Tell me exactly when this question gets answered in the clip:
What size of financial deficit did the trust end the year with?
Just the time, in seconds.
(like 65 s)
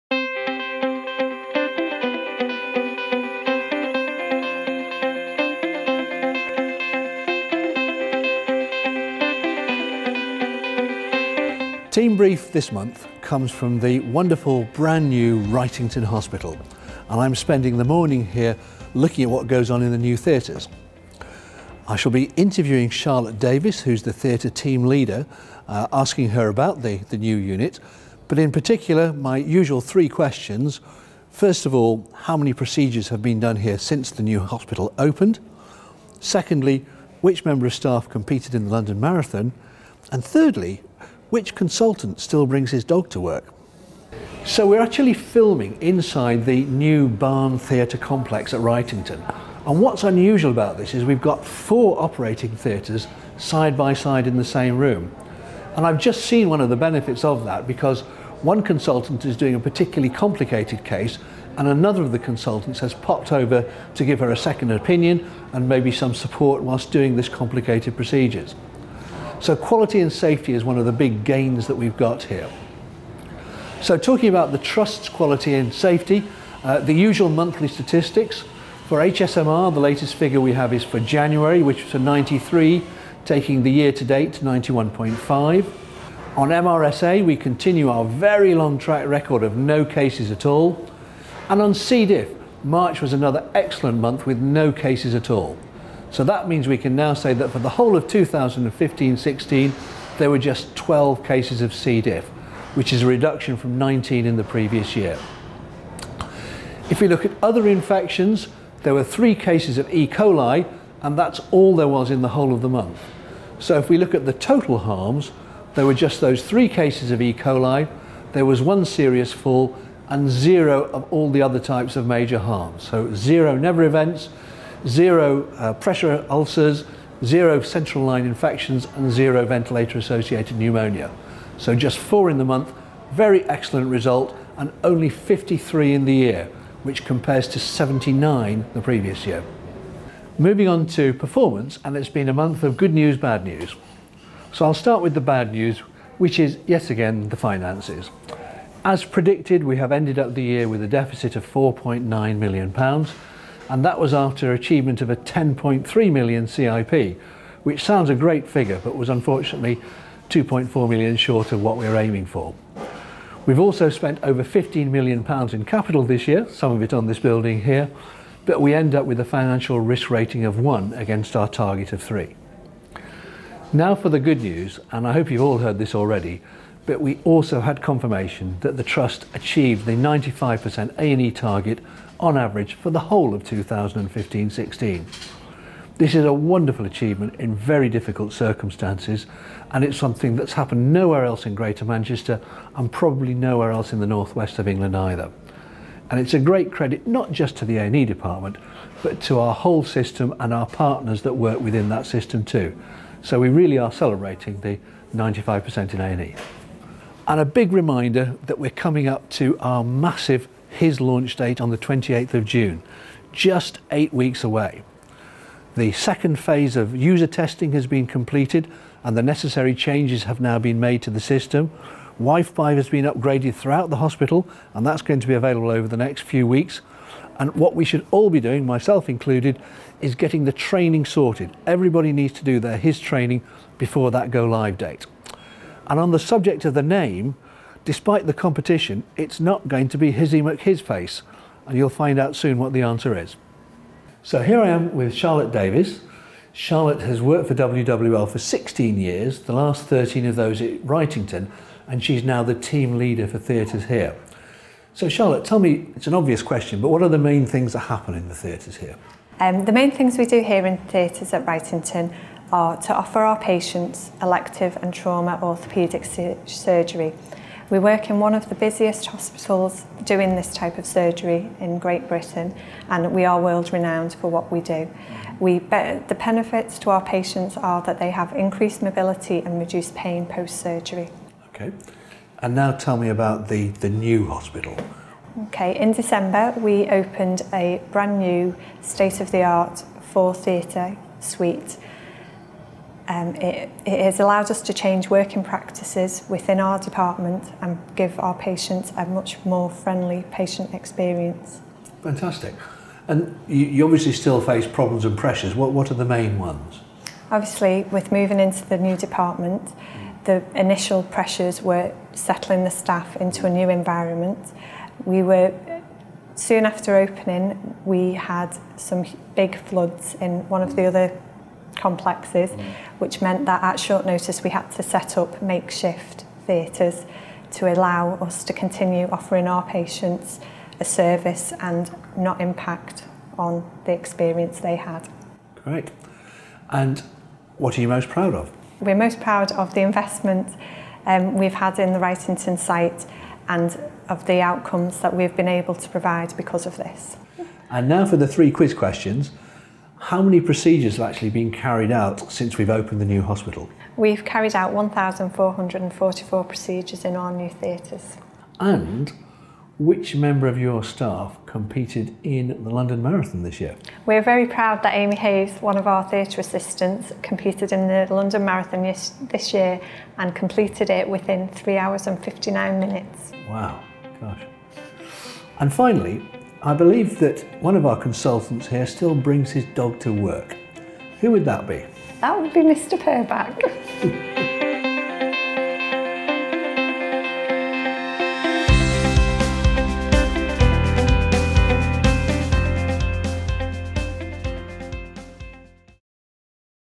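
151 s.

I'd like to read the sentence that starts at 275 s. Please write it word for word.
We the benefits to our patients are that they have increased mobility and reduced pain post-surgery.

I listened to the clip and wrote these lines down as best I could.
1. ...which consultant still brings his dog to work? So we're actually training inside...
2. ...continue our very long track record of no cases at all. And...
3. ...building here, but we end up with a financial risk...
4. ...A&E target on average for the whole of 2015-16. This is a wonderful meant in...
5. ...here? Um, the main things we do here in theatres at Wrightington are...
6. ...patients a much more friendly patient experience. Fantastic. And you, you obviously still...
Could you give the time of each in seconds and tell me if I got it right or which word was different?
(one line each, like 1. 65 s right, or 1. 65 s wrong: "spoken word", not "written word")
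1. 41 s wrong: "filming", not "training"
2. 87 s right
3. 167 s right
4. 180 s wrong: "achievement", not "meant"
5. 258 s right
6. 298 s right.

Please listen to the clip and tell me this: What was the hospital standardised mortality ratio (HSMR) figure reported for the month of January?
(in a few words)
93.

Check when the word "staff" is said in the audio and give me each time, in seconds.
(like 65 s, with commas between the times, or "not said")
37 s, 312 s, 360 s.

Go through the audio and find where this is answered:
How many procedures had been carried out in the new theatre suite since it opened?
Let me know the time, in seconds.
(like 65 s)
354 s.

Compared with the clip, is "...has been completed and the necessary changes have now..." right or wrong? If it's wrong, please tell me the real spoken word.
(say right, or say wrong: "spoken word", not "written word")
right.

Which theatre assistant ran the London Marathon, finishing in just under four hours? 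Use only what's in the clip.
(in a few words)
Amy Hayes.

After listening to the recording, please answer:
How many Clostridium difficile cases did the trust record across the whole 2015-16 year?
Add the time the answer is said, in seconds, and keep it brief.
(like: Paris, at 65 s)
12, at 100 s.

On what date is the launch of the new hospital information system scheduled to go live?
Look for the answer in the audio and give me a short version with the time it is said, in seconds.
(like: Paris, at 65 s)
28th of June, at 211 s.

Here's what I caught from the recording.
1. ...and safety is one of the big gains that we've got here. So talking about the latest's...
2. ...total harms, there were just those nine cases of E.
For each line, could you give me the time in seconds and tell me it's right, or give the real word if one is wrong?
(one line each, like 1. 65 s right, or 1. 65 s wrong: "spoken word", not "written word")
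1. 70 s wrong: "trust", not "latest"
2. 114 s wrong: "three", not "nine".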